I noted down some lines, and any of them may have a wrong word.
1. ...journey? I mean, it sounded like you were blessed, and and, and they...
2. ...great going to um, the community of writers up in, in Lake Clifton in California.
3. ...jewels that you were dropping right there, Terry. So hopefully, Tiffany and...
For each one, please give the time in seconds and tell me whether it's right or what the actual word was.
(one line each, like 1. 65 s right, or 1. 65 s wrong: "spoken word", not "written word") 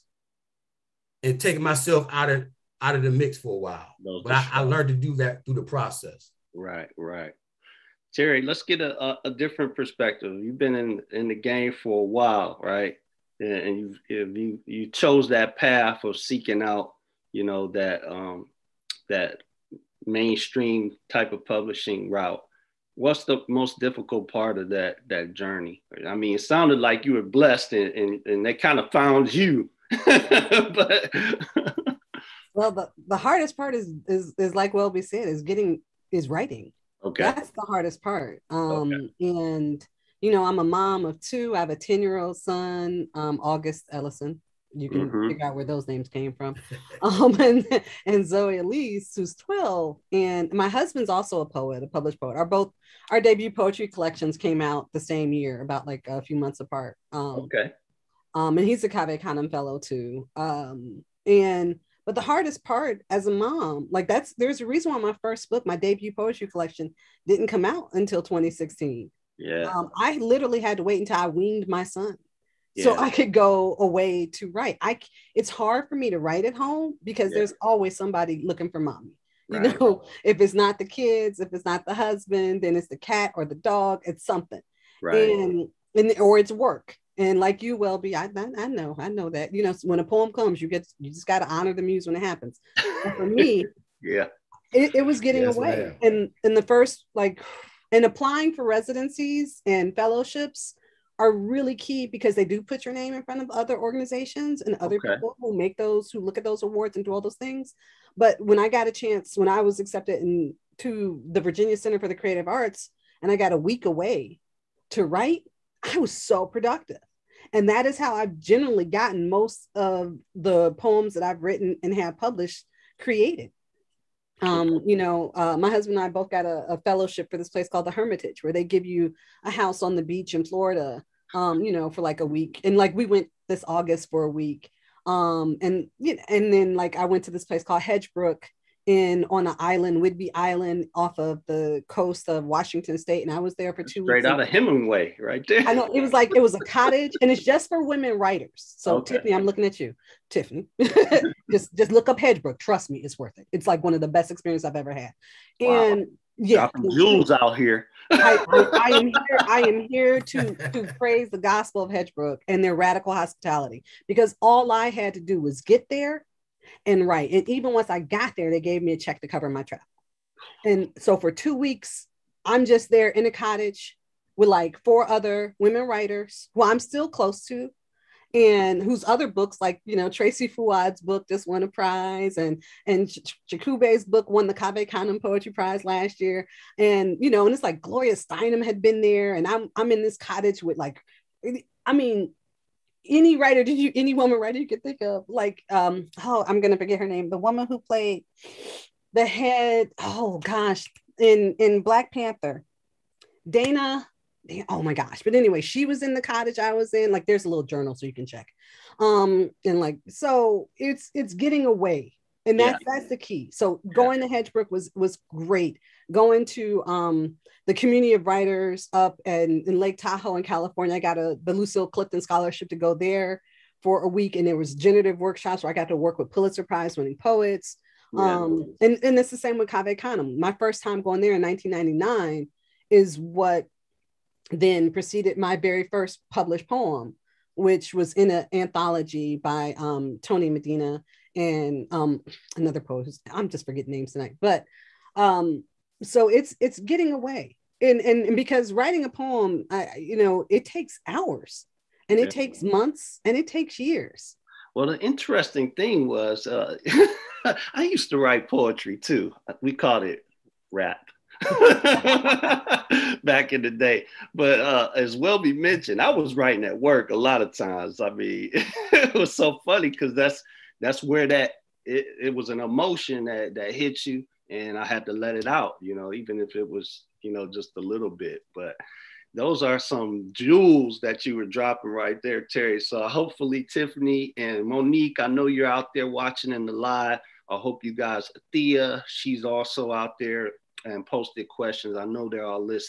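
1. 25 s right
2. 215 s wrong: "Tahoe", not "Clifton"
3. 280 s right.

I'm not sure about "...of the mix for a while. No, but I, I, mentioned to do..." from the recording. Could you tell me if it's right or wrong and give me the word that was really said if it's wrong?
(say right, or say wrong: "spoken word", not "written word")
wrong: "learned", not "mentioned".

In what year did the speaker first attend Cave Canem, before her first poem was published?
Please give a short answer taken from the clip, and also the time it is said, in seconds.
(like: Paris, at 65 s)
1999, at 231 s.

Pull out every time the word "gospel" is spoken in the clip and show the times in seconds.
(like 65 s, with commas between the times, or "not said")
161 s.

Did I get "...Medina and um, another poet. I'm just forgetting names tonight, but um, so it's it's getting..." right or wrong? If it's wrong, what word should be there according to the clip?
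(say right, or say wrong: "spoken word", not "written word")
right.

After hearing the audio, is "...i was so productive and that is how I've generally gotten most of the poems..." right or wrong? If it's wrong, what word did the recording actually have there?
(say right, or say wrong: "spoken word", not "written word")
right.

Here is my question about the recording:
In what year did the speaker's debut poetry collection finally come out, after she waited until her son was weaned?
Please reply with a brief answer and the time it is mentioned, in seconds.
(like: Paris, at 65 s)
2016, at 68 s.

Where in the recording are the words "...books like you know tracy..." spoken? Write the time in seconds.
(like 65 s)
179 s.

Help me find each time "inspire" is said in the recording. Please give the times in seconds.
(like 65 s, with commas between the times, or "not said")
not said.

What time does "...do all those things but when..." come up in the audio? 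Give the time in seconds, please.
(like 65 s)
107 s.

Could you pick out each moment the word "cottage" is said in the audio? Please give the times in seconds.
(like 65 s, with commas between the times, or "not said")
146 s, 173 s, 190 s, 206 s.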